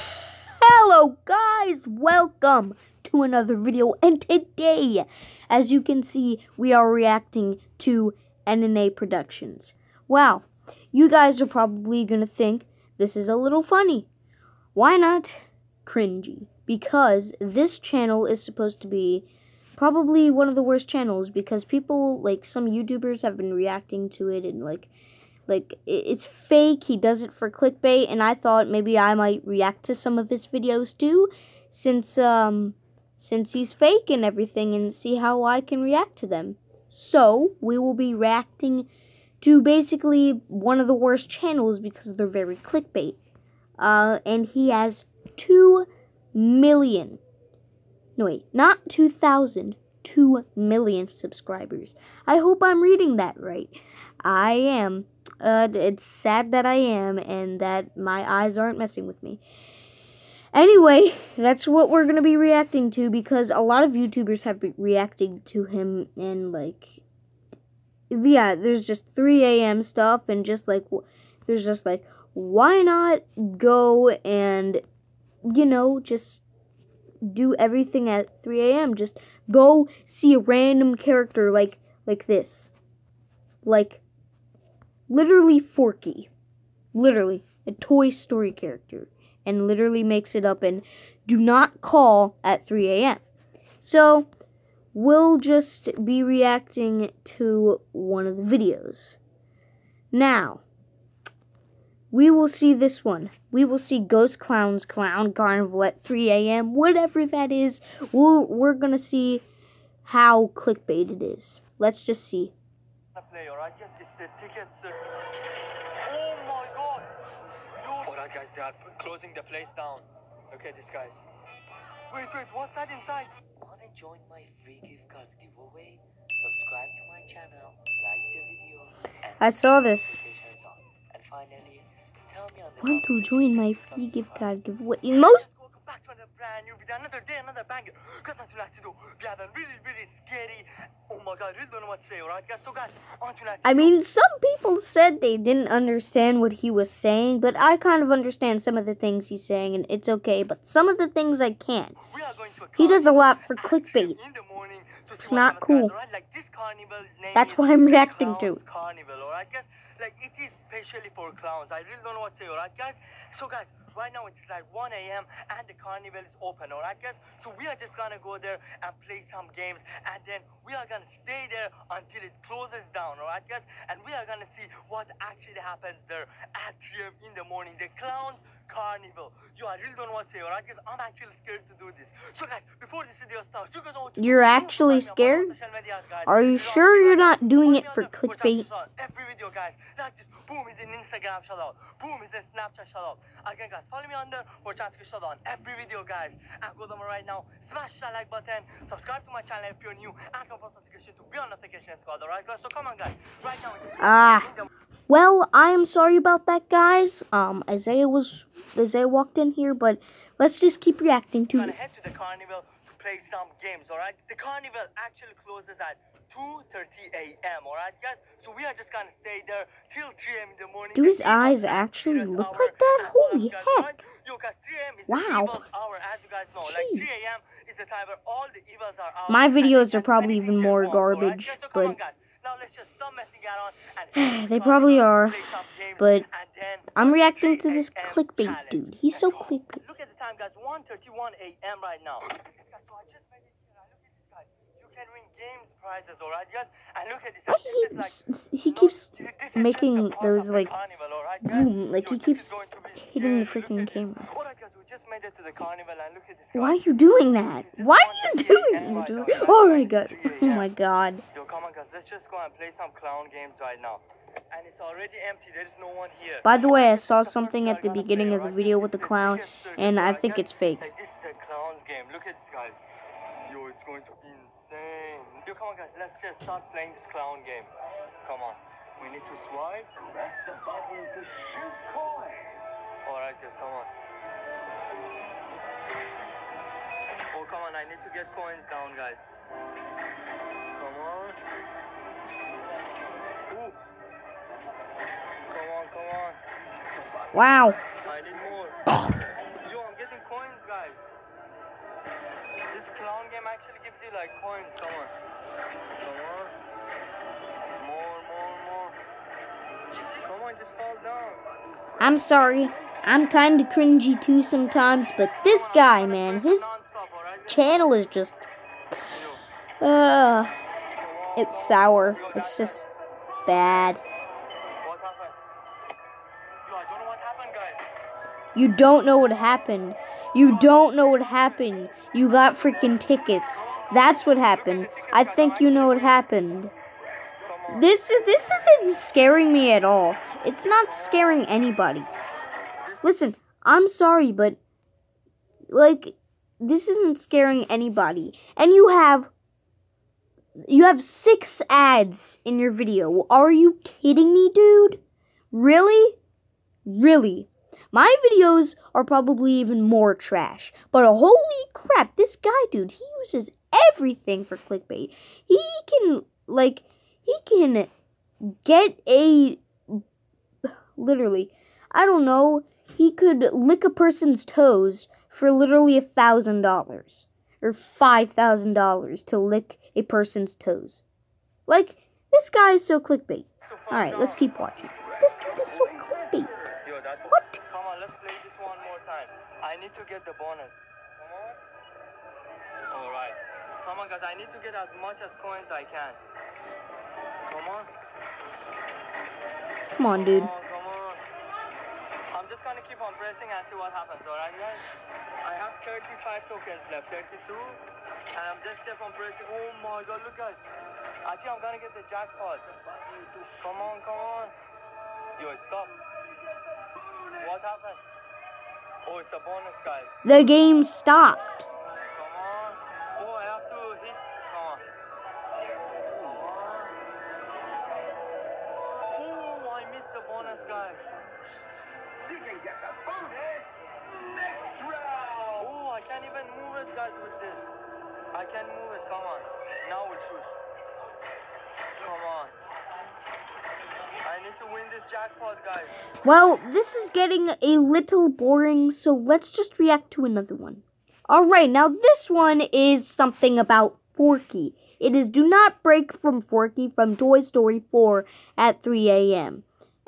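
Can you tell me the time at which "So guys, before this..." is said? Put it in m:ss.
3:02.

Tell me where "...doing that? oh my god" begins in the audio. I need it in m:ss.
4:18.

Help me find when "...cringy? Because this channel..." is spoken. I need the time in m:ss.
0:15.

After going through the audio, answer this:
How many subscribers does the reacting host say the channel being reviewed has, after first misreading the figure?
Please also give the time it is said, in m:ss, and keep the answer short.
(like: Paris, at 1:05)
2 million, at 0:50.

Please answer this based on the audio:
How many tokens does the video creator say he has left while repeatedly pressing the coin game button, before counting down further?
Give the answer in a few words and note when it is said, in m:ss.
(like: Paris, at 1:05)
35, at 6:45.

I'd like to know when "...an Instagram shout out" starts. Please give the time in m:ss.
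3:10.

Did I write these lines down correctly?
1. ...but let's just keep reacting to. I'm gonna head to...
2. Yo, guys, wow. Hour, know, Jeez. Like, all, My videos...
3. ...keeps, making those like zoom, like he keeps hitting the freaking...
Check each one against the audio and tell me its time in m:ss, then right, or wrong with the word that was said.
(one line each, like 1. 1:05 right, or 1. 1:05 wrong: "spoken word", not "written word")
1. 3:29 right
2. 3:44 right
3. 4:08 right.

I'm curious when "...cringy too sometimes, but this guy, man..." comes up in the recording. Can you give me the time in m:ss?
5:13.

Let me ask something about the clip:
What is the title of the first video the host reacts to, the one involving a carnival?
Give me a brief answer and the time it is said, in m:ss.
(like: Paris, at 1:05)
Ghost Clown's Clown Carnival, at 1:43.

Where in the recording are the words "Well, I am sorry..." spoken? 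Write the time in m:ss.
3:25.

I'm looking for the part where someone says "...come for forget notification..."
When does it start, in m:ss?
3:20.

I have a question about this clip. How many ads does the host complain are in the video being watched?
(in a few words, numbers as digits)
6.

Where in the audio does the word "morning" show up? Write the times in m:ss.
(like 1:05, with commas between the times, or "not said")
2:57, 3:40.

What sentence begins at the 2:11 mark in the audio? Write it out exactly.
Finally, Want to join my free gift card giveaway?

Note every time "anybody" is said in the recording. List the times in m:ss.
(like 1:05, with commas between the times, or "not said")
5:41, 5:47.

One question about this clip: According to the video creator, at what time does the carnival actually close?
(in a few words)
2:30 a.m.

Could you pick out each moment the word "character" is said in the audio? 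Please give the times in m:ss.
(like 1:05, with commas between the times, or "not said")
1:20, 1:28.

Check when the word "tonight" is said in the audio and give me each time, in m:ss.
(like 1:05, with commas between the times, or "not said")
2:18, 2:23.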